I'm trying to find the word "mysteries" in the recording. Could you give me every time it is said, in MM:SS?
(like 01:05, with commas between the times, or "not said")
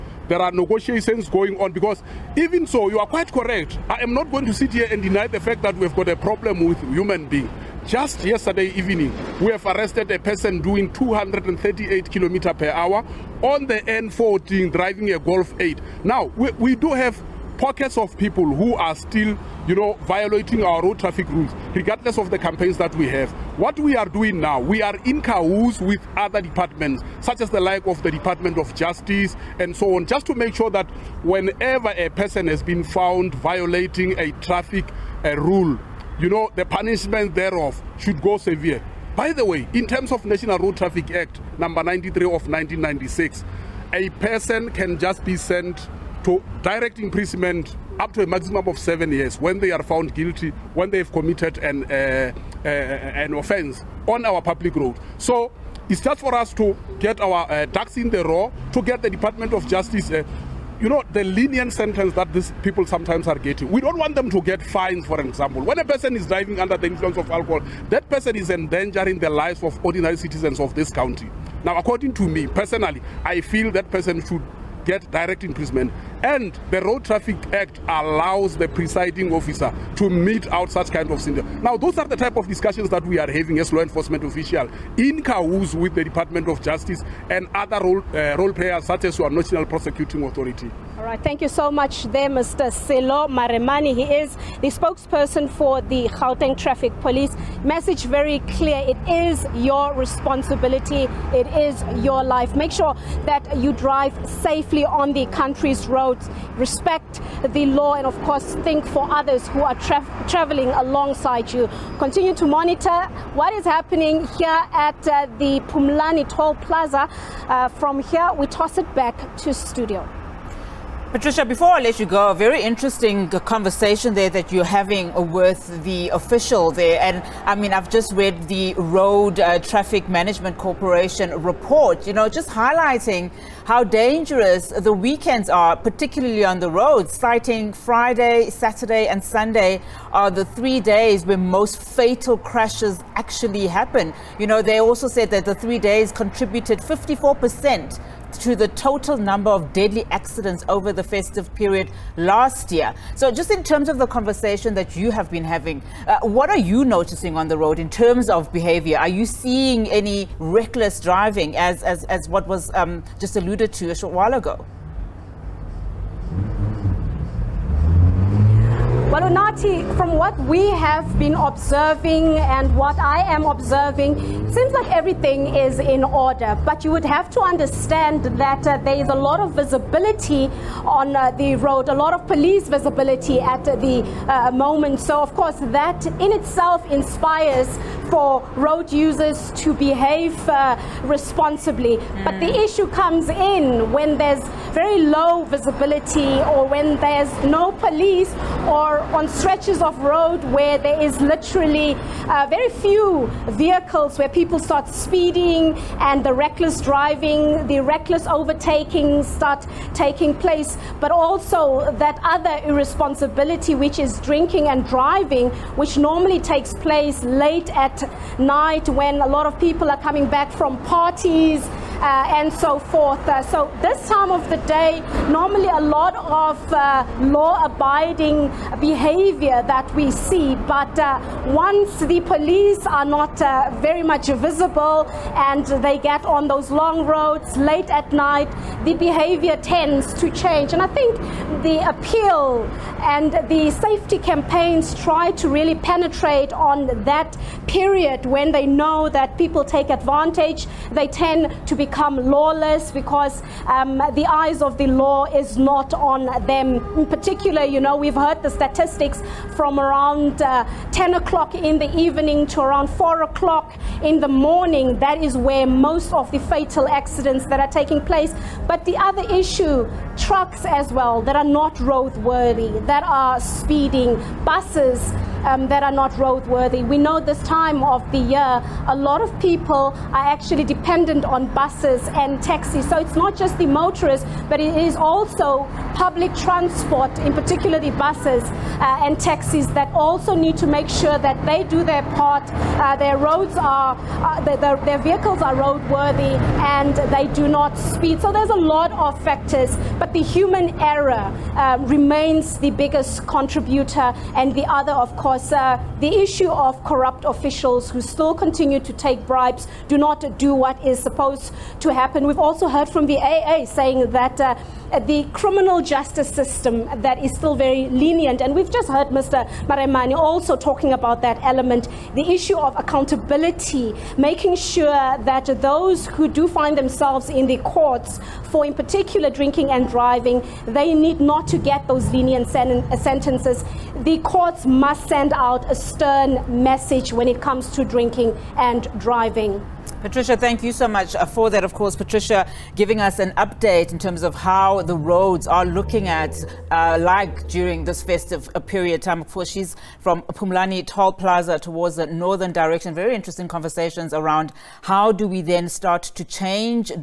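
not said.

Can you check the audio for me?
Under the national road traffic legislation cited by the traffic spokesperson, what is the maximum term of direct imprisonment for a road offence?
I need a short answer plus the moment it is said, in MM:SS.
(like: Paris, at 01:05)
7 years, at 00:48.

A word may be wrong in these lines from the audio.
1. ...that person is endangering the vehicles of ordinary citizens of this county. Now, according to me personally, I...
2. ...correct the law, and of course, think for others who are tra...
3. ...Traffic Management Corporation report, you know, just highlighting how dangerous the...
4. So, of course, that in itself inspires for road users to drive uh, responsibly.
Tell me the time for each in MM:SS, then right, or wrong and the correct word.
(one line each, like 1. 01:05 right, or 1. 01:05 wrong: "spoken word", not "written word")
1. 01:07 wrong: "lives", not "vehicles"
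2. 01:46 wrong: "respect", not "correct"
3. 02:09 right
4. 03:05 wrong: "behave", not "drive".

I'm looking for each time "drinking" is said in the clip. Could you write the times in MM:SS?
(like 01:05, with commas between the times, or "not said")
03:34, 05:29, 05:37.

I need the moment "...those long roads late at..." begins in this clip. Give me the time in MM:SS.
03:56.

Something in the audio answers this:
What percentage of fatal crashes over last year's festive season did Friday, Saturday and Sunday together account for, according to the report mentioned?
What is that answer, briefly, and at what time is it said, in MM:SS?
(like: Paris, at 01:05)
54%, at 02:26.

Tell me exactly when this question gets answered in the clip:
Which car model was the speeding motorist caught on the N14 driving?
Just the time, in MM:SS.
00:15.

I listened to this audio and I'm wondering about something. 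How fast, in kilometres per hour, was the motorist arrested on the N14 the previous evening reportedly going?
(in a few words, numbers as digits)
238.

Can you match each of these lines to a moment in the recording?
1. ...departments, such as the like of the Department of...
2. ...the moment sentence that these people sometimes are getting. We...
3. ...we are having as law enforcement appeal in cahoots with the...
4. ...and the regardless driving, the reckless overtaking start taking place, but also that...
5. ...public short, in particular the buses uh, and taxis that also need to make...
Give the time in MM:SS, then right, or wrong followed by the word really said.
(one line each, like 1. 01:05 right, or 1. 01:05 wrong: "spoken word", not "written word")
1. 00:26 right
2. 01:01 wrong: "lenient", not "moment"
3. 01:23 wrong: "official", not "appeal"
4. 03:26 wrong: "reckless", not "regardless"
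5. 04:45 wrong: "transport", not "short".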